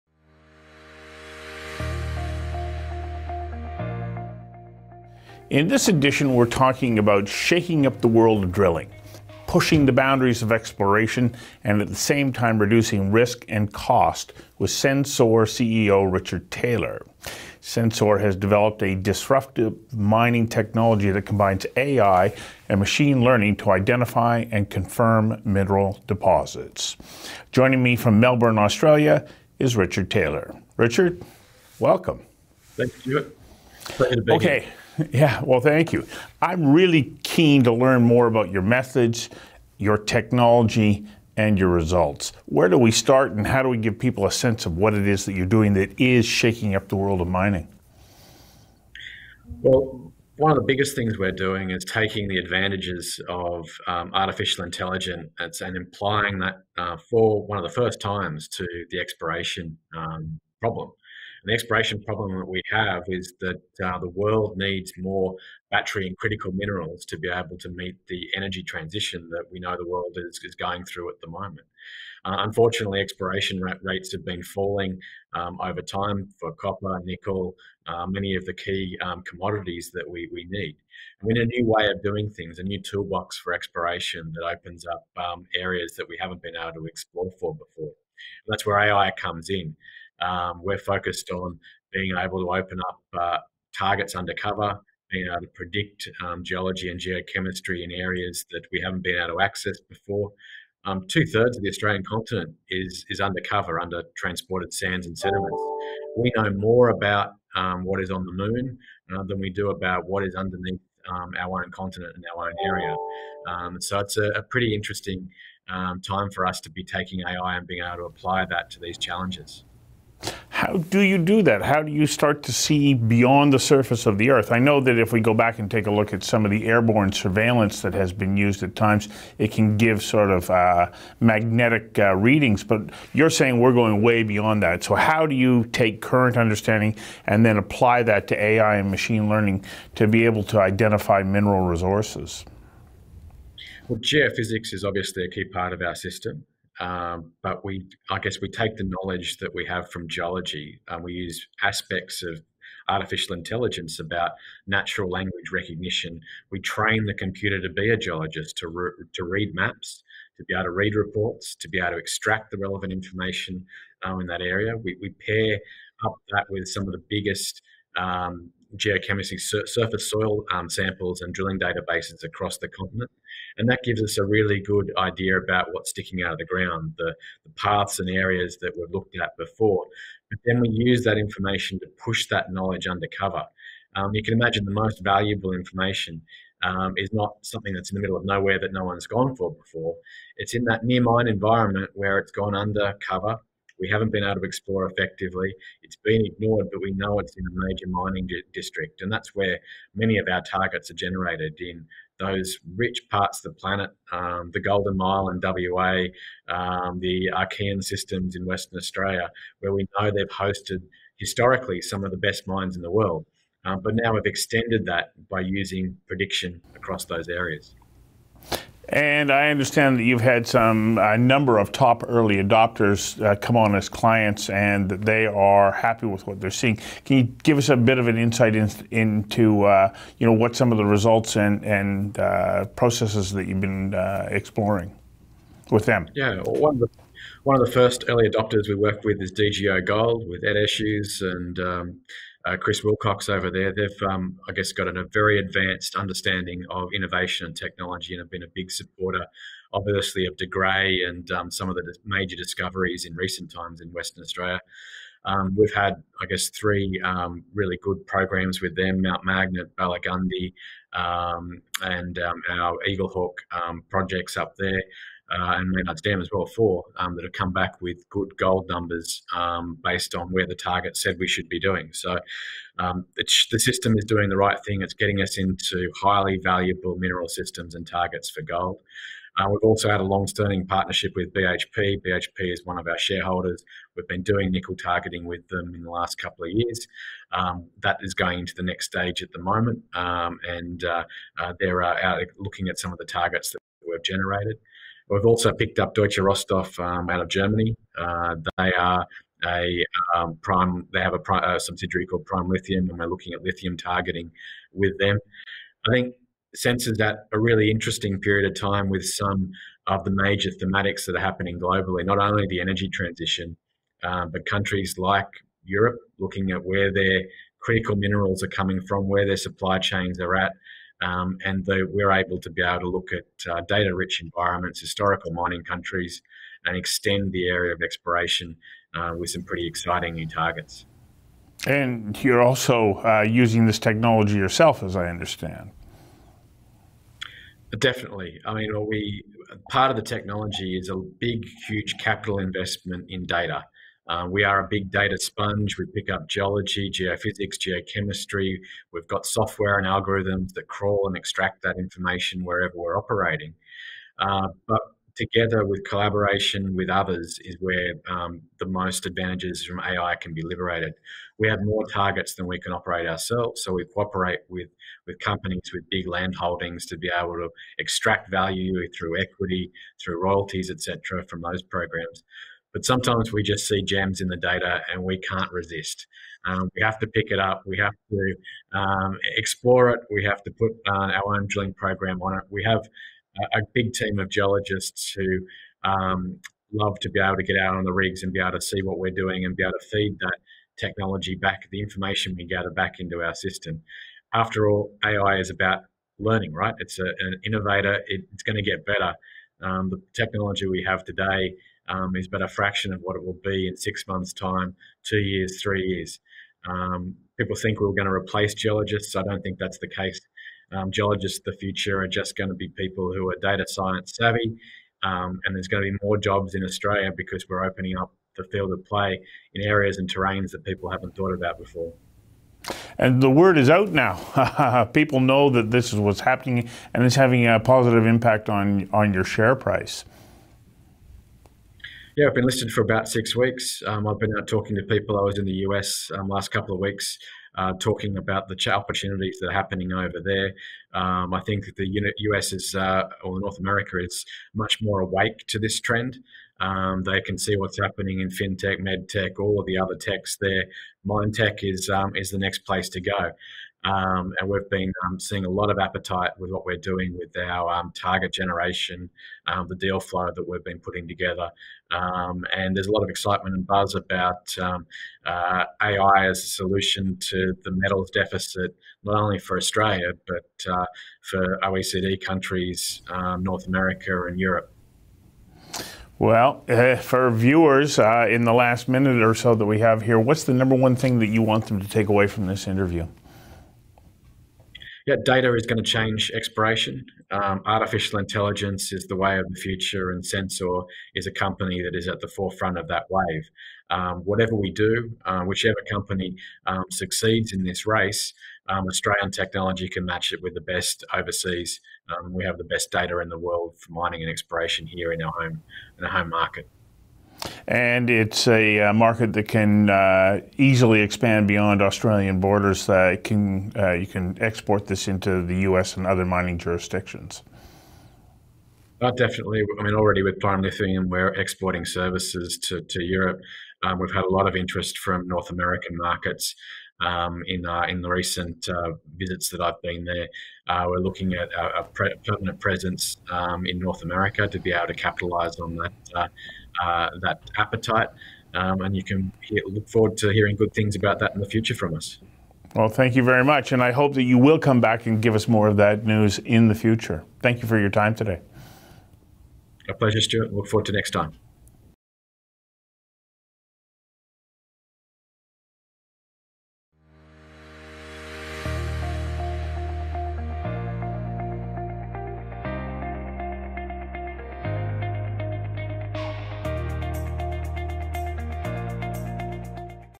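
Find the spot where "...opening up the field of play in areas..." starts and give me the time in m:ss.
6:57.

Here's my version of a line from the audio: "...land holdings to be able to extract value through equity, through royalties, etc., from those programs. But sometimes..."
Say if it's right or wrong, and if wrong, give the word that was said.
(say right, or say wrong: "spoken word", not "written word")
right.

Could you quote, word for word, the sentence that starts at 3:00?
But then we use that information to push that knowledge undercover.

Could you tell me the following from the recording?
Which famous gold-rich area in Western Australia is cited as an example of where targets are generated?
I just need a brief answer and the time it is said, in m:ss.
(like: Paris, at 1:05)
Golden Mile, at 3:24.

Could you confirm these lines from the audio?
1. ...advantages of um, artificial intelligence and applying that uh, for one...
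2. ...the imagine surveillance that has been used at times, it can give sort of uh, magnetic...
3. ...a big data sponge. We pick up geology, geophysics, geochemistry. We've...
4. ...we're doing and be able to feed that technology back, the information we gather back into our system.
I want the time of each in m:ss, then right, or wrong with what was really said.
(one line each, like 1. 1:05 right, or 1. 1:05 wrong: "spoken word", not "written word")
1. 0:52 right
2. 2:06 wrong: "airborne", not "imagine"
3. 5:44 right
4. 6:28 right.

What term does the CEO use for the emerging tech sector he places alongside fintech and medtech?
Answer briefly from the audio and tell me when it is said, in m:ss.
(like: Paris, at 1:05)
Mindtech, at 7:31.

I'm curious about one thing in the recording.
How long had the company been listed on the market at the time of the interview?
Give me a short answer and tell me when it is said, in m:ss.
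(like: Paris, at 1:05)
about 6 weeks, at 7:12.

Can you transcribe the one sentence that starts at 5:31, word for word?
And you're also uh, using this technology yourself, as I understand.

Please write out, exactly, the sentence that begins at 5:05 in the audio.
I think senses that a really interesting period of time with some of the major thematics that are happening globally.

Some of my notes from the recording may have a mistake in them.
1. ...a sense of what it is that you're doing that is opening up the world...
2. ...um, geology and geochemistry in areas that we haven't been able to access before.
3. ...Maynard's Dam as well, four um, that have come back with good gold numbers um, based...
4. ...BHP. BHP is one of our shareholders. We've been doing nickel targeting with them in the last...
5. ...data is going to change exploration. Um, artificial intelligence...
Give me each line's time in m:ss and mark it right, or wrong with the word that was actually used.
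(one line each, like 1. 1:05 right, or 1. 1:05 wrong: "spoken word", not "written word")
1. 0:44 wrong: "shaking", not "opening"
2. 1:36 right
3. 4:25 right
4. 4:41 right
5. 8:05 right.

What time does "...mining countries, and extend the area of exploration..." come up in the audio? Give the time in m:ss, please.
5:25.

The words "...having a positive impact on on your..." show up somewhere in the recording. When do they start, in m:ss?
7:07.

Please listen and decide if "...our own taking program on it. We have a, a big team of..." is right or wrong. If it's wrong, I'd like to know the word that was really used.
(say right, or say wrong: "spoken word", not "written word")
wrong: "drilling", not "taking".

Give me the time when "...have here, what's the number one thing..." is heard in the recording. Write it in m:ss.
7:59.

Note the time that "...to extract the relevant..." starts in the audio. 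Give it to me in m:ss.
2:41.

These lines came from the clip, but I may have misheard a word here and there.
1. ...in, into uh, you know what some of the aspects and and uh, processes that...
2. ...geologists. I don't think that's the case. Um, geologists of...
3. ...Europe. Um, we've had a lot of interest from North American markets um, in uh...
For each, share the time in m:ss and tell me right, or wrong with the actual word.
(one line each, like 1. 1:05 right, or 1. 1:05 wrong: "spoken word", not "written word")
1. 3:48 wrong: "results", not "aspects"
2. 6:48 right
3. 8:43 right.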